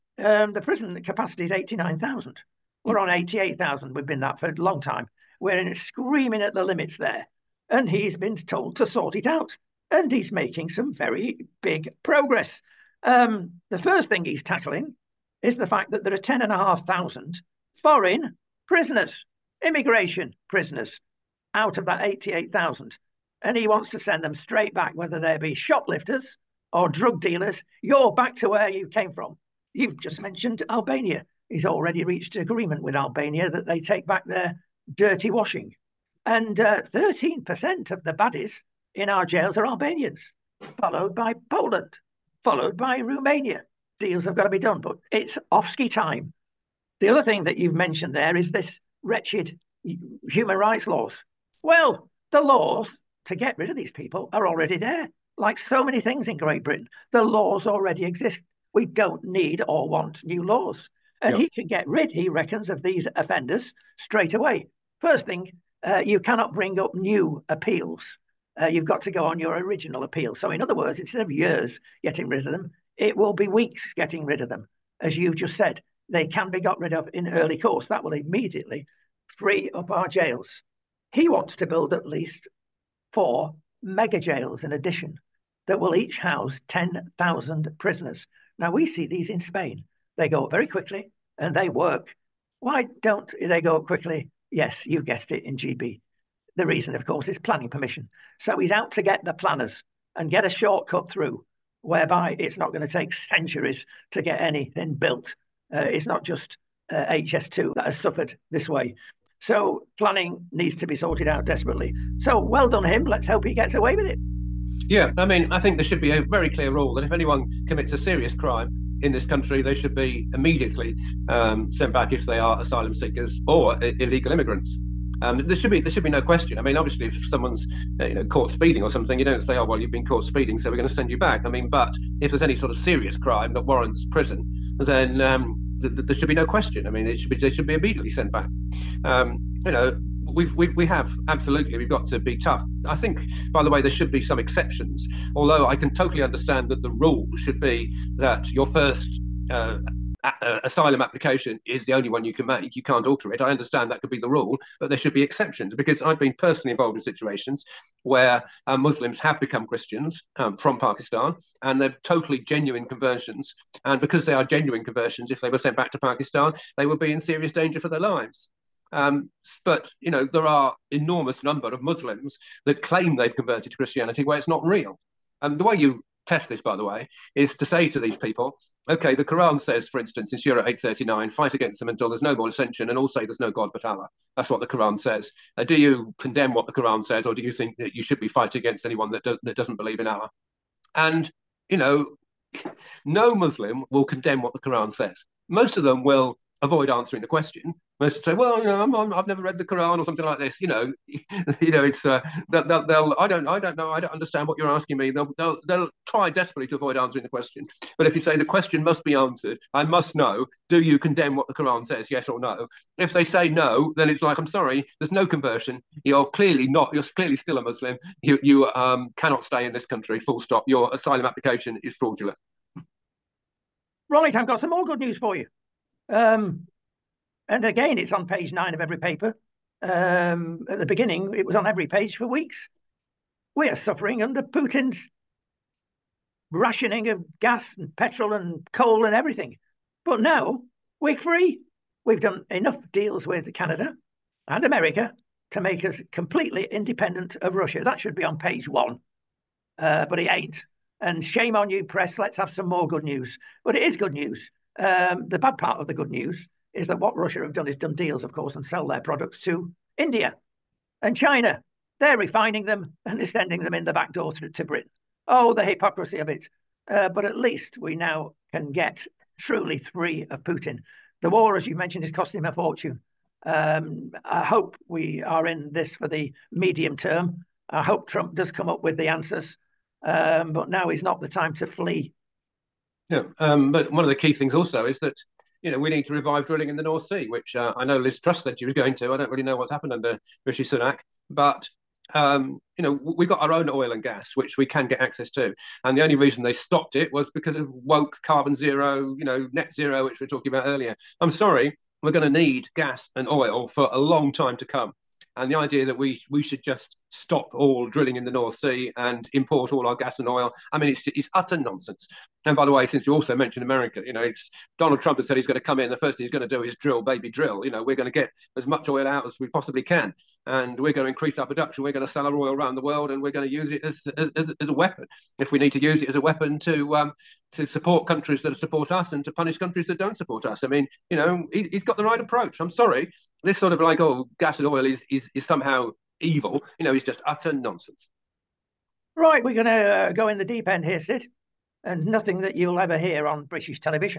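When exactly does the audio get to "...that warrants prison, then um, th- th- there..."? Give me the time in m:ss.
2:13.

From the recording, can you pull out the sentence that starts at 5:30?
I mean, you know, he, he's got the right approach.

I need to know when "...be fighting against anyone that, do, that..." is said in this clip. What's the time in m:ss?
3:08.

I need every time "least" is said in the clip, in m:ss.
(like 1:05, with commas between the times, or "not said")
1:22, 4:27.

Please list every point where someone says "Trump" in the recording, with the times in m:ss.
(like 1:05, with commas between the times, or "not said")
4:38, 5:15.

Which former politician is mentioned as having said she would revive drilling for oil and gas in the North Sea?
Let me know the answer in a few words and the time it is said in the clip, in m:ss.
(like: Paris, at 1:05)
Liz Truss, at 4:47.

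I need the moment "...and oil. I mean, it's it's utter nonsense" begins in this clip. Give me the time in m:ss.
5:10.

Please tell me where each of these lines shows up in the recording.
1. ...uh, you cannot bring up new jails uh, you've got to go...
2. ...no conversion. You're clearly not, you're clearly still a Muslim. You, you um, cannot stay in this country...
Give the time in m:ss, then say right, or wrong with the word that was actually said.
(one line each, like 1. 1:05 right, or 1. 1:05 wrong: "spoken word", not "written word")
1. 1:05 wrong: "appeals", not "jails"
2. 3:35 right.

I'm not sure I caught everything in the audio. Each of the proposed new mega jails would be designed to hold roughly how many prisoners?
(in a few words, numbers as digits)
10,000.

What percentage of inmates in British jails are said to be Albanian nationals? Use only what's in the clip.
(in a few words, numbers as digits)
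13%.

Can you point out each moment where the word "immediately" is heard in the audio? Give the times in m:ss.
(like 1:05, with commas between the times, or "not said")
1:18, 2:00, 2:17.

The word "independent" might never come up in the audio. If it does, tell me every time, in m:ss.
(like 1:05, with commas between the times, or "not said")
4:06.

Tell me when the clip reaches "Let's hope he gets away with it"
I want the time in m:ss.
1:53.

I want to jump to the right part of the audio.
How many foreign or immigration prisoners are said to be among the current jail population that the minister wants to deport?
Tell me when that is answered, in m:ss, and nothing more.
0:16.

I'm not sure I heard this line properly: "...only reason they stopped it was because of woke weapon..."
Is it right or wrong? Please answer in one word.
wrong.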